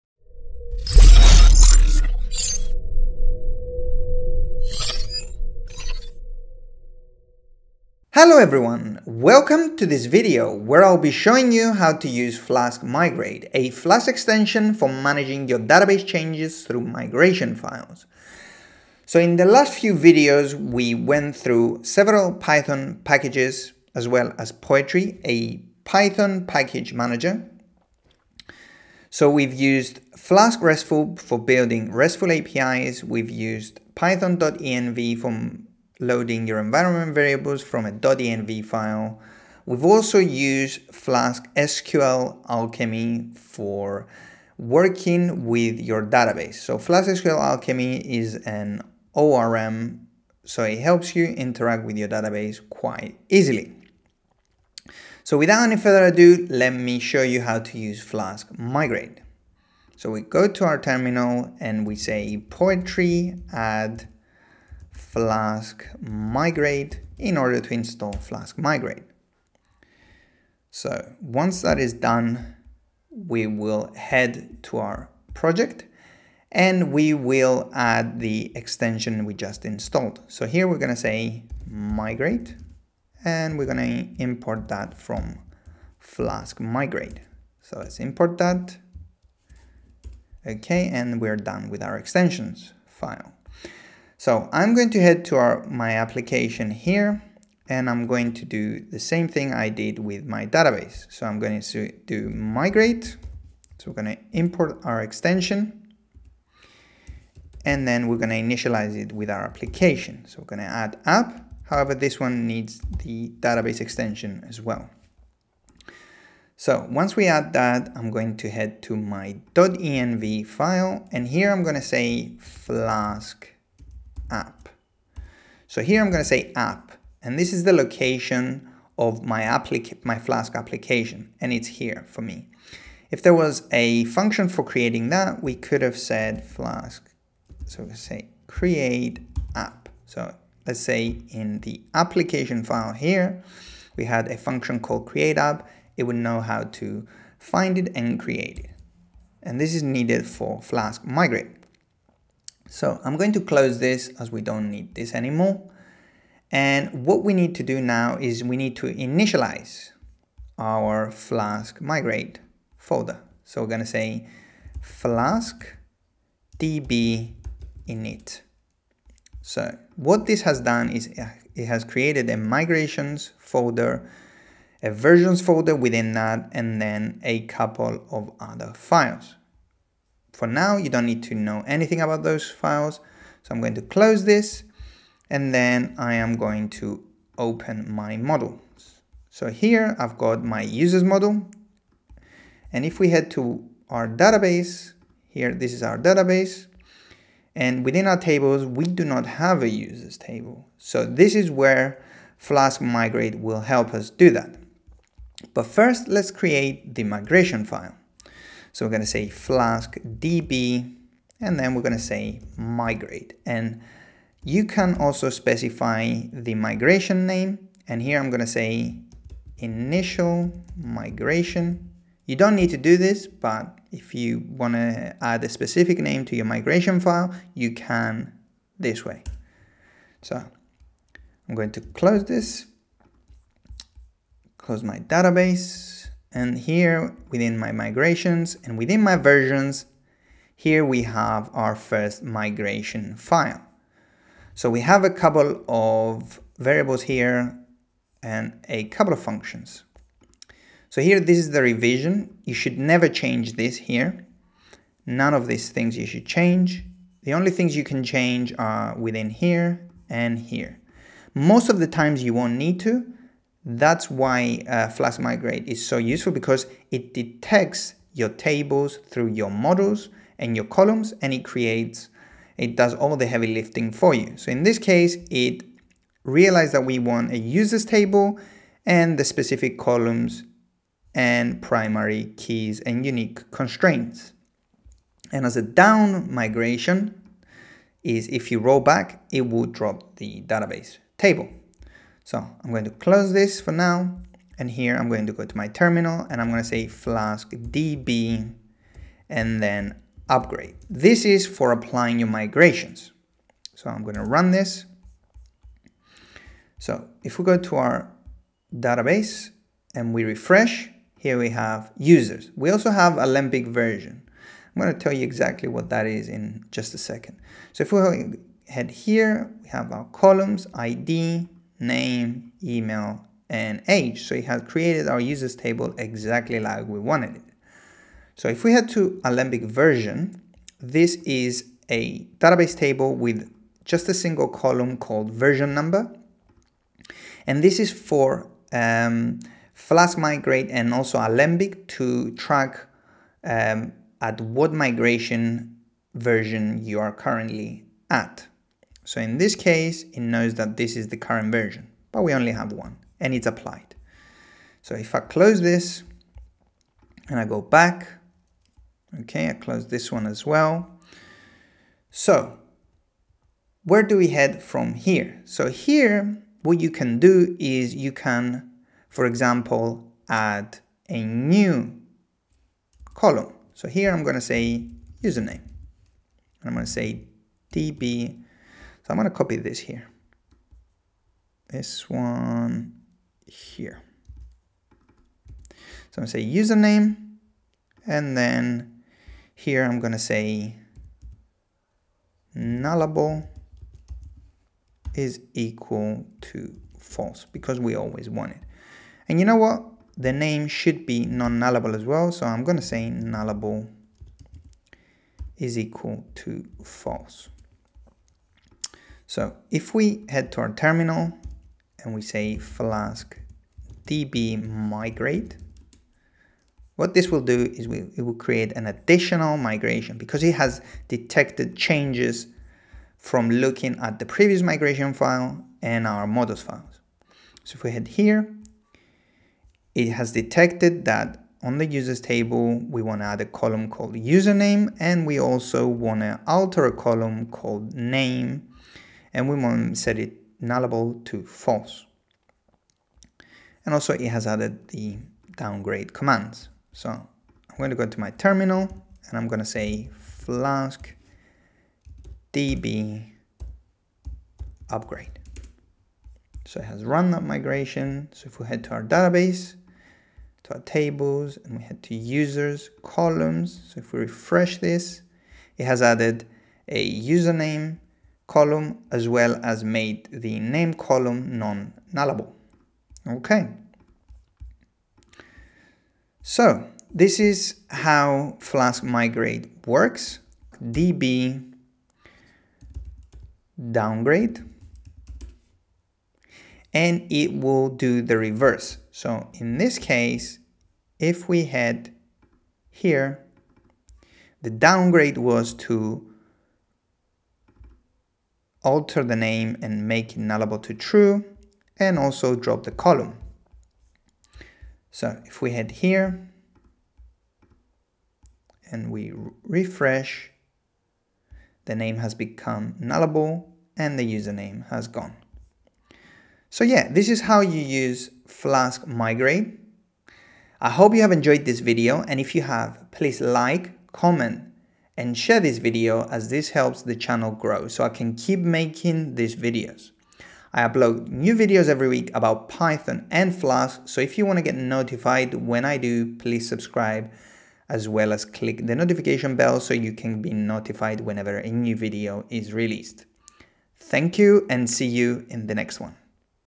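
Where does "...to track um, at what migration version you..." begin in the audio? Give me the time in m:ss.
5:41.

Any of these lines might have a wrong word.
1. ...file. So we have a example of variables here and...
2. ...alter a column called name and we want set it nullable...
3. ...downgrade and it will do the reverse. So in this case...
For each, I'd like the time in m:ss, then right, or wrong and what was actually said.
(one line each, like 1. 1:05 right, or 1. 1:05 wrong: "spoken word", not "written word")
1. 4:03 wrong: "couple", not "example"
2. 7:16 right
3. 8:03 right.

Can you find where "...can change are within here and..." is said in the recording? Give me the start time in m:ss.
4:17.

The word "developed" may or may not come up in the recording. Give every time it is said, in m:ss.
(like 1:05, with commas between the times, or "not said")
not said.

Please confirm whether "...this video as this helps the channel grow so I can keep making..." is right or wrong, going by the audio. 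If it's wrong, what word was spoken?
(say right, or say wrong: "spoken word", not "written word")
right.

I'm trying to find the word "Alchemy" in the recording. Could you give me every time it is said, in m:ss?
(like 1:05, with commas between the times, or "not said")
0:42, 0:47.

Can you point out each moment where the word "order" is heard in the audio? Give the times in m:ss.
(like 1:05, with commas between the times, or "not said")
1:07.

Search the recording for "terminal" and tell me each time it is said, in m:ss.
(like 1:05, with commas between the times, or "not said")
1:00, 4:55, 6:50, 7:28.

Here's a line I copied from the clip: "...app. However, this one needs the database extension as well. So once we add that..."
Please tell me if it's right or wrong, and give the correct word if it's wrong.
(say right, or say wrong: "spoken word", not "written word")
right.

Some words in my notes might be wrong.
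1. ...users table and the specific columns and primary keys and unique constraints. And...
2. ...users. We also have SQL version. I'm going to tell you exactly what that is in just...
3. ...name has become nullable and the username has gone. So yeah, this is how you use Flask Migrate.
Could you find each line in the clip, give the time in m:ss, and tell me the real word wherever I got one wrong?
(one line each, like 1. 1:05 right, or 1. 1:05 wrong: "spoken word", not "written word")
1. 4:37 right
2. 5:11 wrong: "Alembic", not "SQL"
3. 8:31 right.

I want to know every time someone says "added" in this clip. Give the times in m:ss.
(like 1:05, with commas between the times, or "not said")
7:24, 7:46.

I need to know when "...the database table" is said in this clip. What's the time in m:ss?
4:50.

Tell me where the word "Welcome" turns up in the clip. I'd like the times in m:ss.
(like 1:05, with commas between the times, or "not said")
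0:09.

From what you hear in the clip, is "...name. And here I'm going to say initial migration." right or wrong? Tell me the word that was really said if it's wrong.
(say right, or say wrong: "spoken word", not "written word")
right.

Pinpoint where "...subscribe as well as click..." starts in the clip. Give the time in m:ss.
8:56.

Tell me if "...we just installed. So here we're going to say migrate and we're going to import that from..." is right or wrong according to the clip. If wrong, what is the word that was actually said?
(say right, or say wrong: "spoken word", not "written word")
right.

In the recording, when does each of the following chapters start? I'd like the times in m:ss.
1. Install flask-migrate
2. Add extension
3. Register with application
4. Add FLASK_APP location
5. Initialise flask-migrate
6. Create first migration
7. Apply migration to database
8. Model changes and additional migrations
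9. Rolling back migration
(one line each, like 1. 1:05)
1. 1:00
2. 1:16
3. 1:41
4. 2:00
5. 2:37
6. 3:28
7. 4:56
8. 6:06
9. 8:00.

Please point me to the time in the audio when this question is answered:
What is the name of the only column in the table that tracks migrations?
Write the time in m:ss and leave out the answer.
5:35.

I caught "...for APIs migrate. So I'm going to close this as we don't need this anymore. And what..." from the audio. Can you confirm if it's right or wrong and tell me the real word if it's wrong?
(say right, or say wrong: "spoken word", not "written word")
wrong: "Flask", not "APIs".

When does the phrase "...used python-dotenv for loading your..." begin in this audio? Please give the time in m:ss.
0:33.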